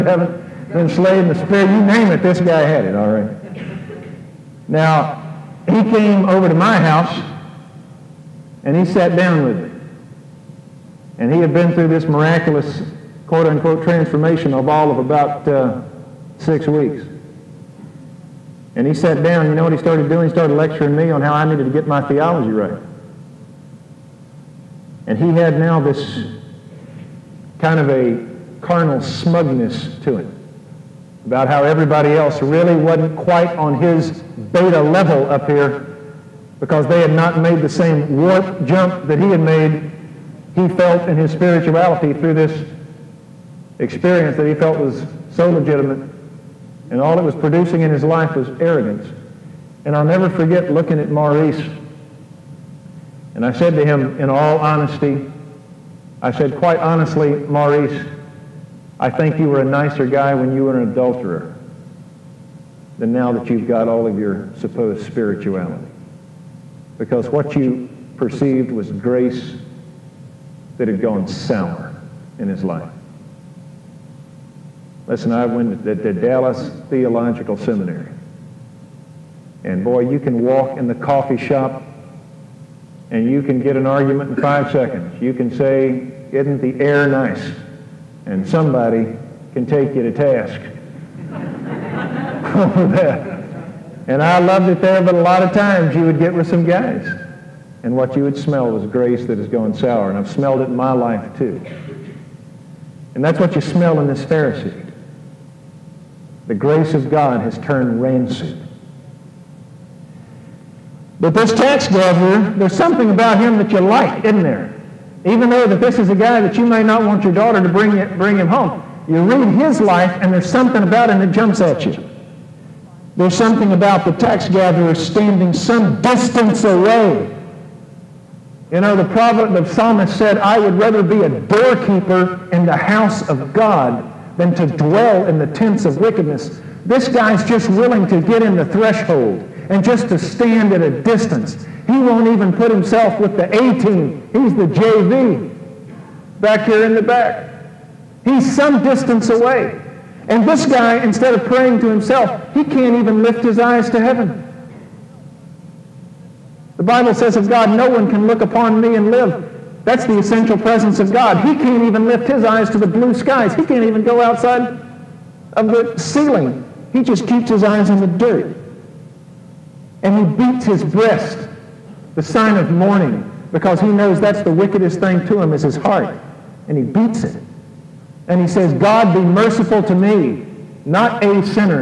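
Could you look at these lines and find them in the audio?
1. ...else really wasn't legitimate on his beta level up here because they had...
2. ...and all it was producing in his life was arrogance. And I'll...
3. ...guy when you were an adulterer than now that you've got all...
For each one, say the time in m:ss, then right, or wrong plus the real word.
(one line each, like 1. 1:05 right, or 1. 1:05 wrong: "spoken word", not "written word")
1. 0:32 wrong: "quite", not "legitimate"
2. 0:46 right
3. 1:00 right.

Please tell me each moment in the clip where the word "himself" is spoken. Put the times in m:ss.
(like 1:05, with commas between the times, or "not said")
2:22, 2:31.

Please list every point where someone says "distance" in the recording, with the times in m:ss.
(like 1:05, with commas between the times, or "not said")
2:06, 2:21, 2:28.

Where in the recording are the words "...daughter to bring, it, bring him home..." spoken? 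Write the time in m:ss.
1:57.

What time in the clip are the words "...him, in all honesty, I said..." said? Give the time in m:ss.
0:53.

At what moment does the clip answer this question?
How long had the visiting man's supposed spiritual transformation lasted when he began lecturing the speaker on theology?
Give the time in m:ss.
0:16.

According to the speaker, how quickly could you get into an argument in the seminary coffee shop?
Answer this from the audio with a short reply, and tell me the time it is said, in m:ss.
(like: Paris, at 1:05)
5 seconds, at 1:24.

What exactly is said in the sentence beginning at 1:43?
And that's what you smell in this Pharisee.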